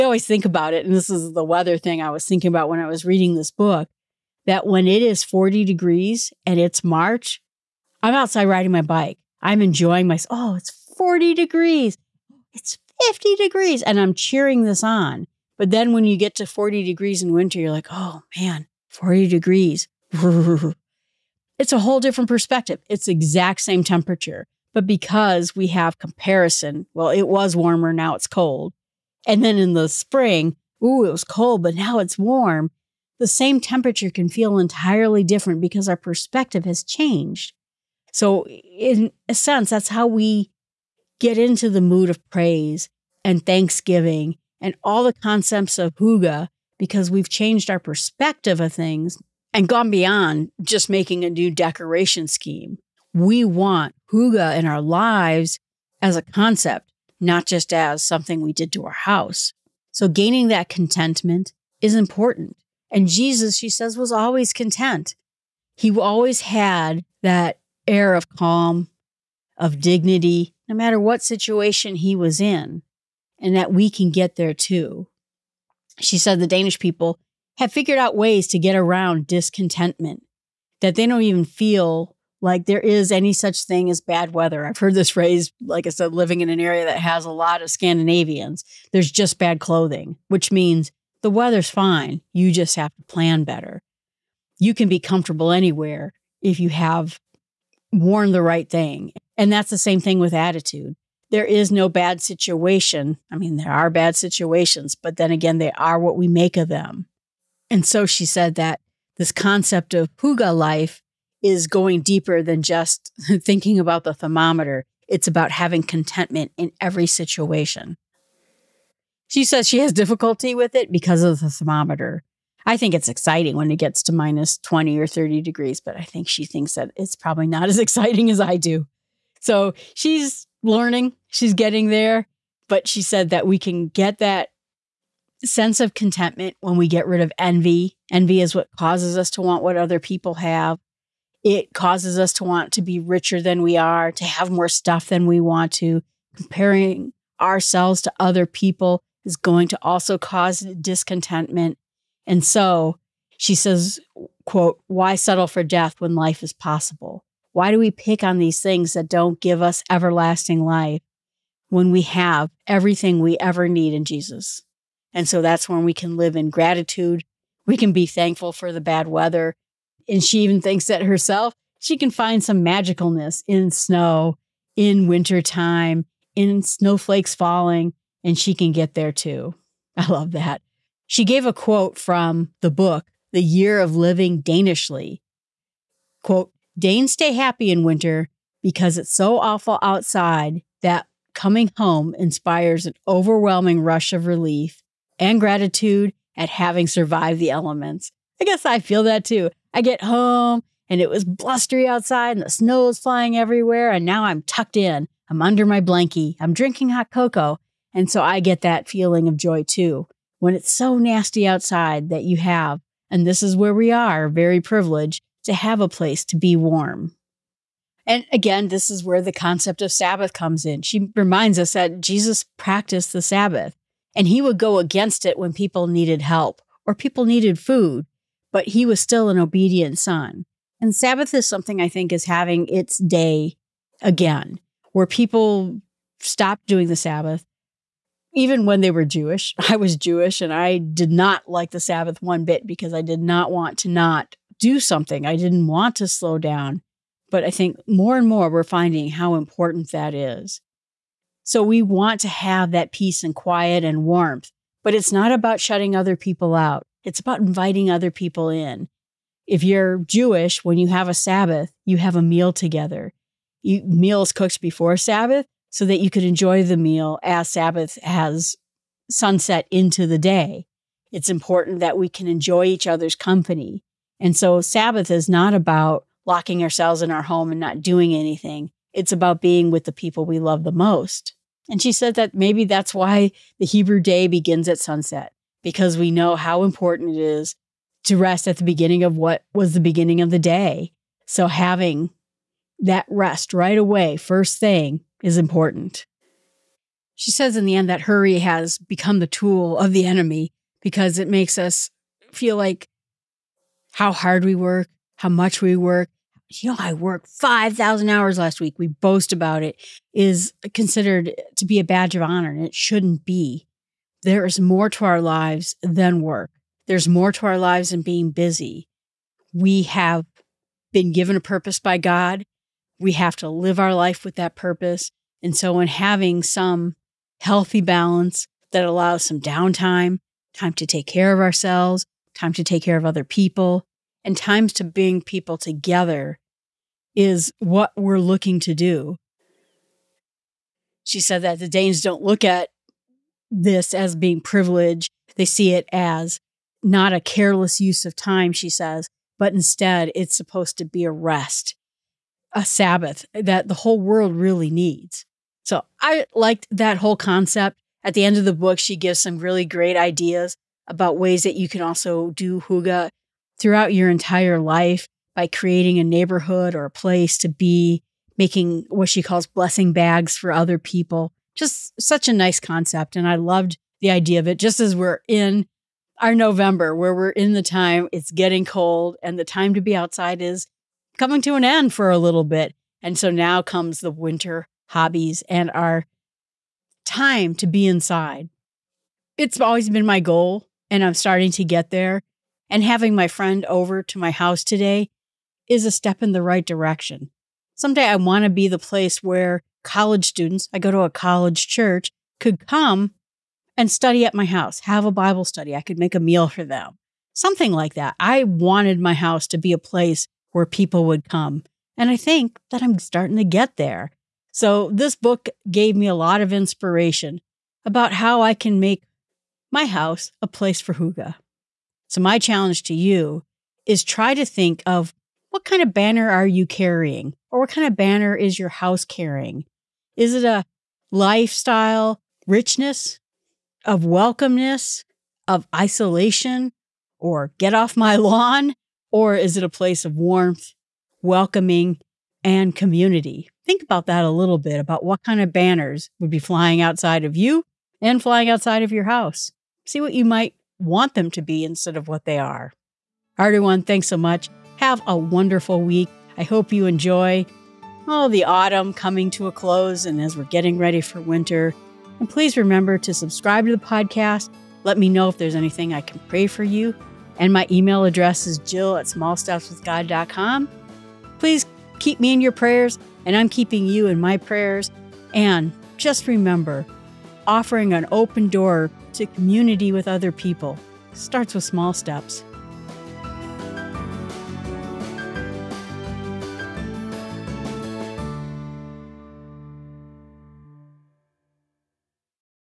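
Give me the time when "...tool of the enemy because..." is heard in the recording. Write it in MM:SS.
04:59.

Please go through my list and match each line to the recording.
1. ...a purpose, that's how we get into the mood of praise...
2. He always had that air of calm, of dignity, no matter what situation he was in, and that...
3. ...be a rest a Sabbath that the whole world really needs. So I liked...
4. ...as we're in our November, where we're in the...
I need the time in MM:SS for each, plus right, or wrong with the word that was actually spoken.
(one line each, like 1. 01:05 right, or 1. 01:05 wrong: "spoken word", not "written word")
1. 00:39 wrong: "sense", not "purpose"
2. 01:05 right
3. 05:50 right
4. 06:14 right.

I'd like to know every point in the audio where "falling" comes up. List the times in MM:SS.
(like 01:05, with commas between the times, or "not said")
02:57.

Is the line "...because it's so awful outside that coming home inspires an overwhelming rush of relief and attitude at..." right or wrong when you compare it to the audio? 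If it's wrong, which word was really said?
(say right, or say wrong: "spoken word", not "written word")
wrong: "gratitude", not "attitude".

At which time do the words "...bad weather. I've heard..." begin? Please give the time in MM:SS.
01:23.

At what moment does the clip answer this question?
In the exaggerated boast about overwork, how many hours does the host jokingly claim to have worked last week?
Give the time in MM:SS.
05:07.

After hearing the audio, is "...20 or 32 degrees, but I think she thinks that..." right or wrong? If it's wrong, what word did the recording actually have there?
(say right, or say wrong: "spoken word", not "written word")
wrong: "30", not "32".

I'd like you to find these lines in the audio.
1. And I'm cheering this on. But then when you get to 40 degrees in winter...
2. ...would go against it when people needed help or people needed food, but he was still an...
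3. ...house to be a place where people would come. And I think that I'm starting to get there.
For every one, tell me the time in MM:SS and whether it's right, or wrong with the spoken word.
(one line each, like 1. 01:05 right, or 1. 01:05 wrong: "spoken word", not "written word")
1. 00:13 right
2. 03:44 right
3. 06:49 right.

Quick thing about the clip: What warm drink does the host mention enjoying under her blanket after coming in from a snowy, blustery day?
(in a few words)
hot cocoa.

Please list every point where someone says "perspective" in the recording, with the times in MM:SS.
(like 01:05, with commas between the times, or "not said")
00:22, 00:35, 00:47.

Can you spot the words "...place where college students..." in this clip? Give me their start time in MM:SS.
06:38.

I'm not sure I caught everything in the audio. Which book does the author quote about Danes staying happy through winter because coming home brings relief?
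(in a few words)
The Year of Living Danishly.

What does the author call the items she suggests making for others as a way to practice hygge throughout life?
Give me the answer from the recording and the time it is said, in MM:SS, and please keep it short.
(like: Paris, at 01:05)
blessing bags, at 06:09.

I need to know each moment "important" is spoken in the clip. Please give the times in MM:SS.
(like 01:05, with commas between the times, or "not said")
01:01, 04:09, 04:31, 04:46, 04:55.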